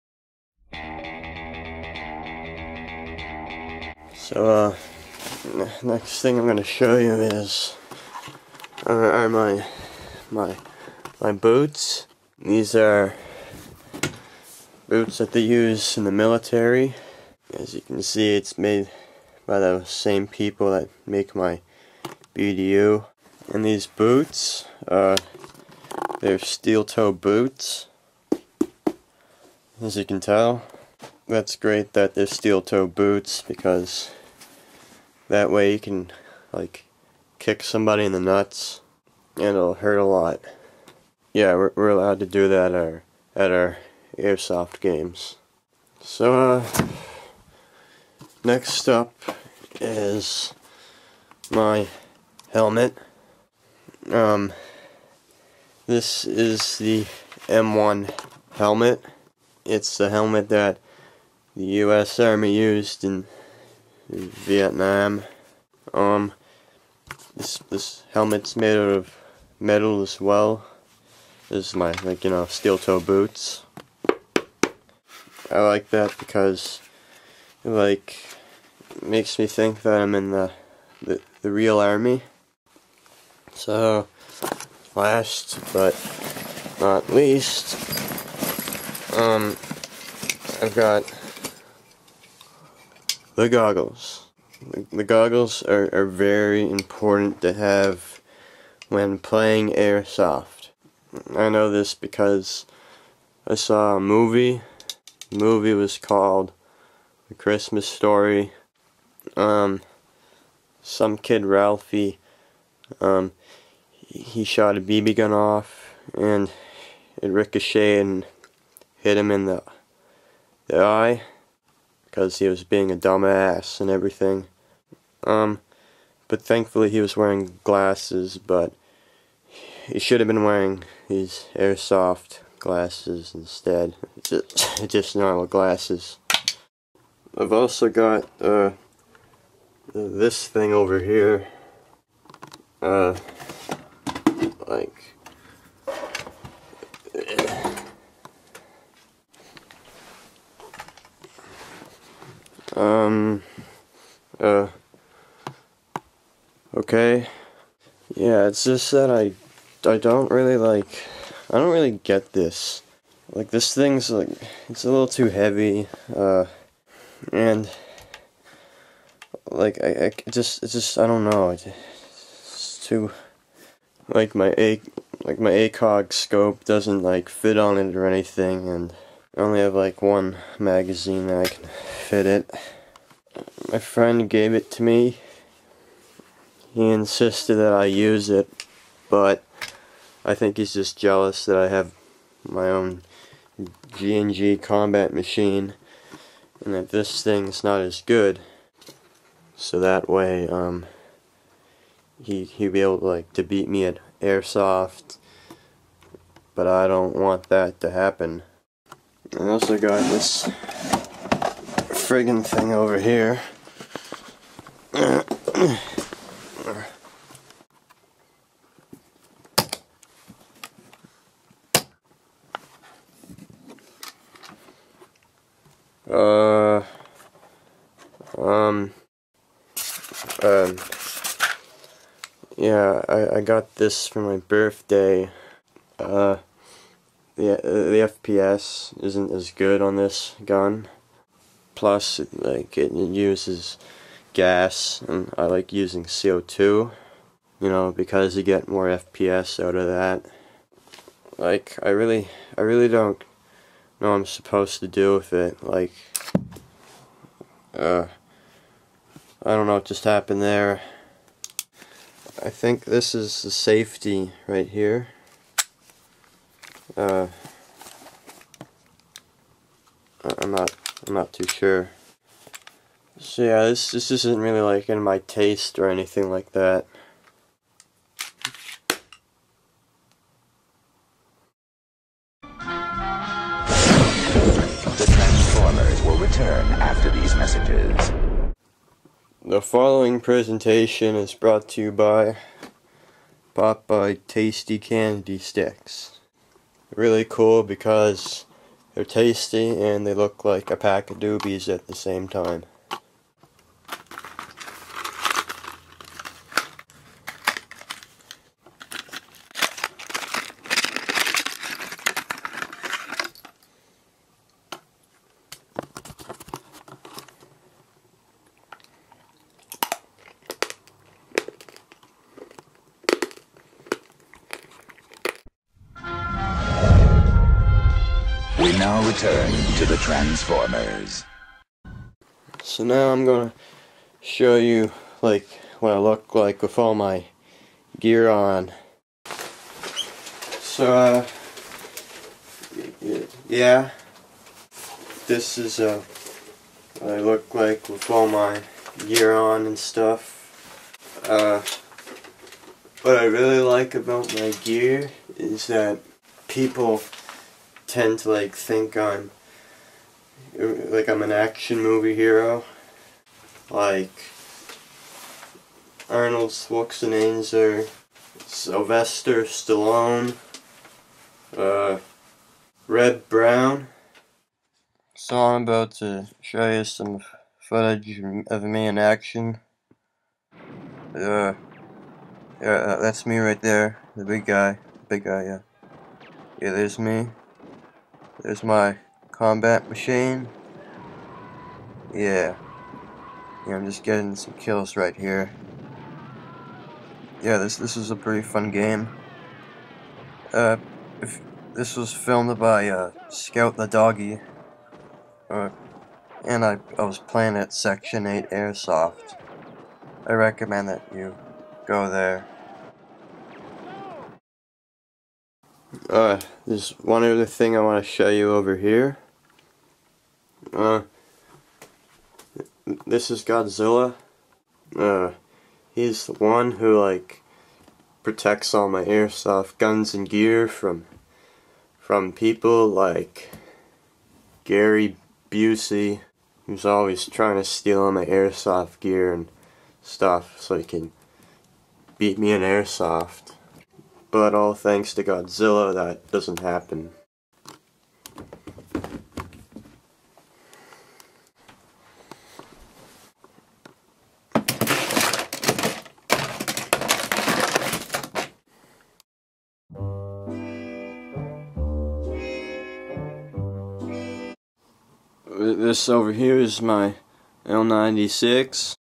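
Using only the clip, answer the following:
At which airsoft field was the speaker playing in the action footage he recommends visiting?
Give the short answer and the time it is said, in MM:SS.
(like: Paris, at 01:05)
Section Eight Airsoft, at 06:47.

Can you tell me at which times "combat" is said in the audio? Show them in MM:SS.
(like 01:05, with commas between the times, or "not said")
03:14, 06:29.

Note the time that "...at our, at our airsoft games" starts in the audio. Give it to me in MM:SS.
00:42.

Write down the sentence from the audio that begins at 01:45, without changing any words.
The movie was called The Christmas Story.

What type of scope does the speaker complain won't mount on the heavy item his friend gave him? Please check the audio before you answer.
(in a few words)
ACOG.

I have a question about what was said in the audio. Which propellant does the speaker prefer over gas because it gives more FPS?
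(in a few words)
CO2.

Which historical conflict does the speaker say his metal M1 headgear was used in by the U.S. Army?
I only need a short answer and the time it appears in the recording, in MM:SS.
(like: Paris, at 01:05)
Vietnam, at 01:04.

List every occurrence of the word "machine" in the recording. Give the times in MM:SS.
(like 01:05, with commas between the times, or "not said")
03:15, 06:29.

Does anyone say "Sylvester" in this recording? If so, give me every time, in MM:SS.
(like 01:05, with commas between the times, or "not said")
06:08.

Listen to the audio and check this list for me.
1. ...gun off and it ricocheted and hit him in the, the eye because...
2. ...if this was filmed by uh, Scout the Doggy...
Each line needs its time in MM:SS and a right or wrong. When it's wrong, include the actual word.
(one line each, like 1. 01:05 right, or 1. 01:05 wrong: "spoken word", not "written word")
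1. 01:55 right
2. 06:41 right.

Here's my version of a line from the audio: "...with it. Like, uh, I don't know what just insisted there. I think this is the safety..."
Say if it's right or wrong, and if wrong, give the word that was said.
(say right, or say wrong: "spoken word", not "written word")
wrong: "happened", not "insisted".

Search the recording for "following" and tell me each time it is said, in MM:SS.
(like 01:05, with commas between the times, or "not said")
04:49.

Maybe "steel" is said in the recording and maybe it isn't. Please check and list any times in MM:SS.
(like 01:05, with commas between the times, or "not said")
00:26, 00:32, 01:12.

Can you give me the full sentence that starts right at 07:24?
But all thanks to Godzilla, that doesn't happen.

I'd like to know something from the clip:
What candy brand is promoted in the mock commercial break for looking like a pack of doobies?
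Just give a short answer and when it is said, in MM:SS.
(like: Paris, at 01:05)
Popeye, at 04:53.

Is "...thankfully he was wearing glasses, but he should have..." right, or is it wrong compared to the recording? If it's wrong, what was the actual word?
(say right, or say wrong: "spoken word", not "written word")
right.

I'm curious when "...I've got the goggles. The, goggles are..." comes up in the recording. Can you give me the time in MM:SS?
01:30.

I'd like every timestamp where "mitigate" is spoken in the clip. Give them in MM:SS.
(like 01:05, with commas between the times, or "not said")
not said.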